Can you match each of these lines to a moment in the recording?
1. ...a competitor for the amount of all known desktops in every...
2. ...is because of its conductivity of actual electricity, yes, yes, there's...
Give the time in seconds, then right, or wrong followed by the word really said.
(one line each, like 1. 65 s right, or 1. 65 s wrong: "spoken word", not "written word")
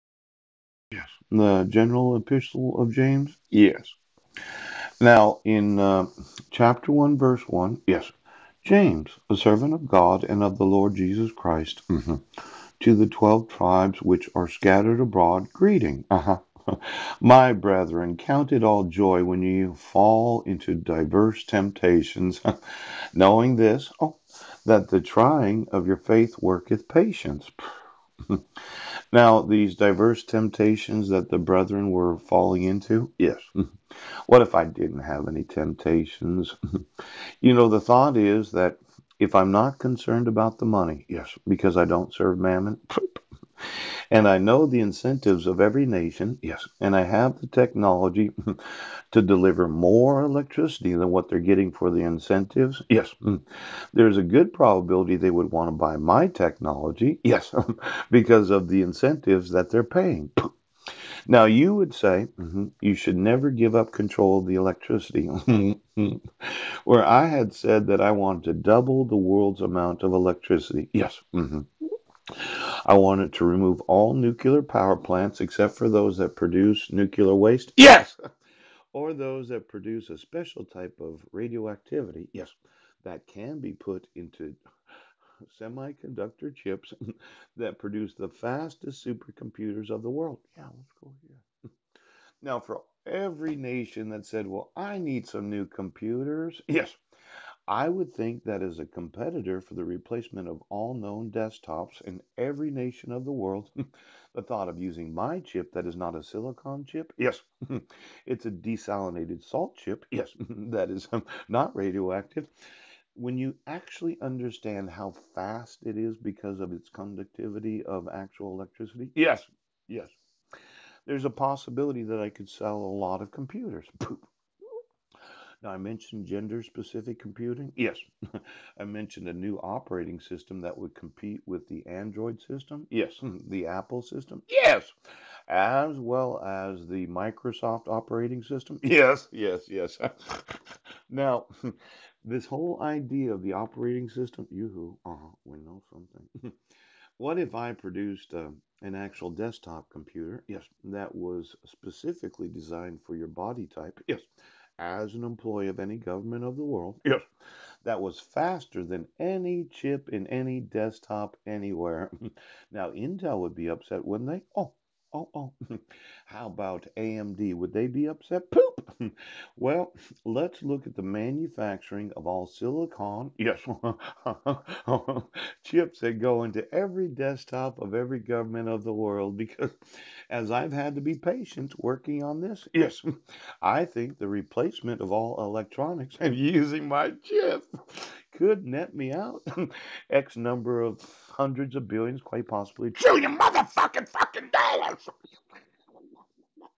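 1. 98 s wrong: "replacement", not "amount"
2. 115 s right.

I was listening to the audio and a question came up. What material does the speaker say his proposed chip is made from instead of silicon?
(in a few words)
Desalinated salt.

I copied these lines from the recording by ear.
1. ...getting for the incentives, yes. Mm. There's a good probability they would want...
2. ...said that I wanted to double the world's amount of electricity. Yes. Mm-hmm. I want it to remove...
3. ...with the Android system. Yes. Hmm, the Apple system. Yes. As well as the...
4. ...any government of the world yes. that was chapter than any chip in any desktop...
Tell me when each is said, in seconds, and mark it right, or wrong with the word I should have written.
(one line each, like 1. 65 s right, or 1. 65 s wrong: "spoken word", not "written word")
1. 51 s right
2. 67 s right
3. 131 s right
4. 155 s wrong: "faster", not "chapter".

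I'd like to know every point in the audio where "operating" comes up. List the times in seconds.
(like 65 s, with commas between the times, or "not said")
129 s, 137 s, 143 s.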